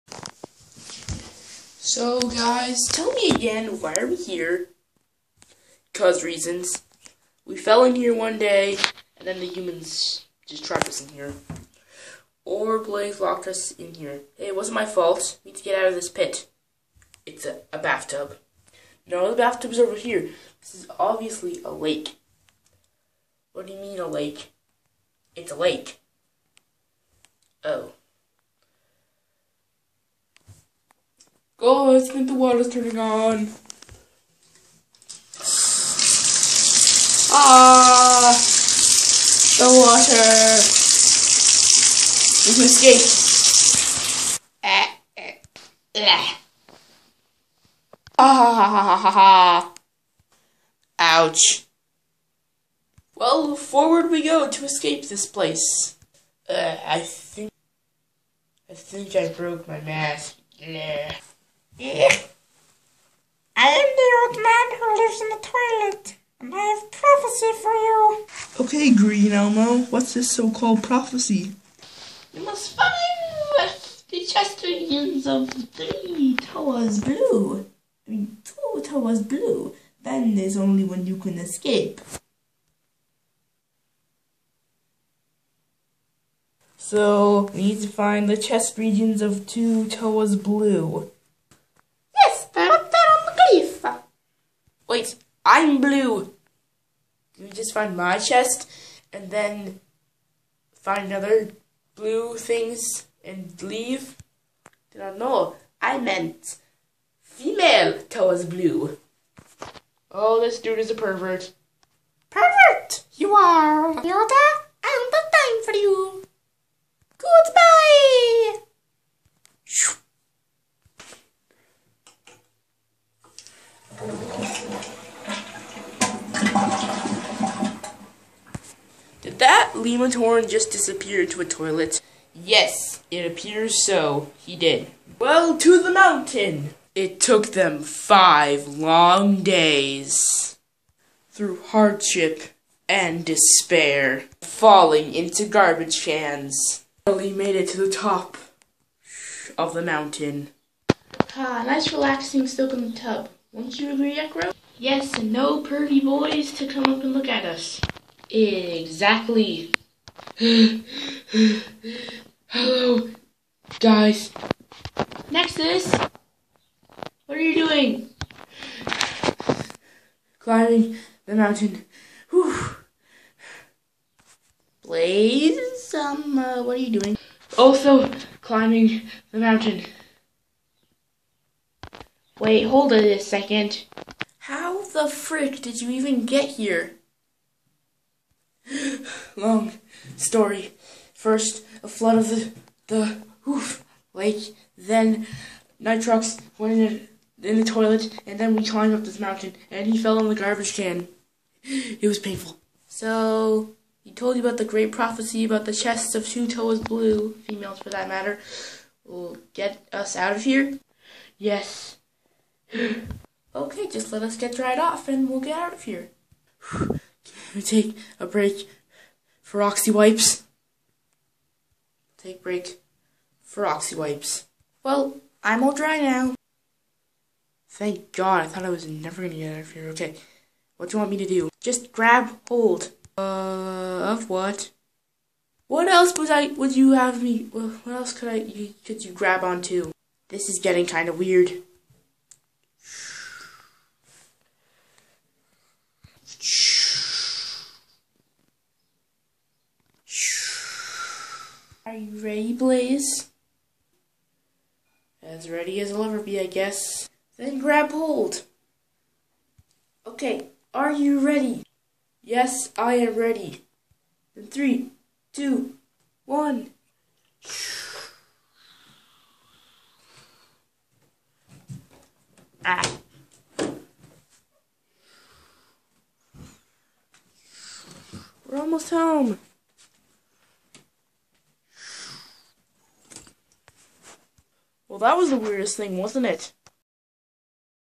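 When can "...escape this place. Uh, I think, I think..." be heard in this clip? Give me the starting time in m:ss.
0:54.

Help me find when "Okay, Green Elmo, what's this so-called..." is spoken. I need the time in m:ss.
1:08.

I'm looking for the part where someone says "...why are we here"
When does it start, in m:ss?
0:03.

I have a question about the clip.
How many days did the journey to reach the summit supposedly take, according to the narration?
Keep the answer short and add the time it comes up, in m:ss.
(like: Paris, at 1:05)
5, at 2:17.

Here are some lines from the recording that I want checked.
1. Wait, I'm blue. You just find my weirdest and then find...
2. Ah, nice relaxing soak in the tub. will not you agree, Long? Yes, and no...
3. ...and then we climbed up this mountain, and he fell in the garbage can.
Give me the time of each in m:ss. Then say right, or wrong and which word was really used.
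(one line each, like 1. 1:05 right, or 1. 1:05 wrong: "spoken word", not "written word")
1. 1:34 wrong: "chest", not "weirdest"
2. 2:31 wrong: "Ekro", not "Long"
3. 3:18 right.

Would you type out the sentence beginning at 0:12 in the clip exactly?
Or Blaze locked us in here.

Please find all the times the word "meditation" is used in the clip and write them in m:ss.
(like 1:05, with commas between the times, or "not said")
not said.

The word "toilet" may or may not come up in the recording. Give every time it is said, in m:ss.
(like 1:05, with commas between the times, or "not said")
1:05, 2:11, 3:17.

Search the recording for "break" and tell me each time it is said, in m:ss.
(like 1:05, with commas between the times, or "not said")
3:38, 3:42.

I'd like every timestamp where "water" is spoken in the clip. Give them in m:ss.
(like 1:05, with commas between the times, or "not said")
0:32, 0:39.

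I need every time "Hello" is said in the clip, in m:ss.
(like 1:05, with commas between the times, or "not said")
2:42.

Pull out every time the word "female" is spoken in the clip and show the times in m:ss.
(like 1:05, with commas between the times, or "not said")
1:47, 3:27.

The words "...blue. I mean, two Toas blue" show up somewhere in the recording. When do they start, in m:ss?
1:17.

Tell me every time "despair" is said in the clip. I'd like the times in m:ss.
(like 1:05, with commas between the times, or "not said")
2:23.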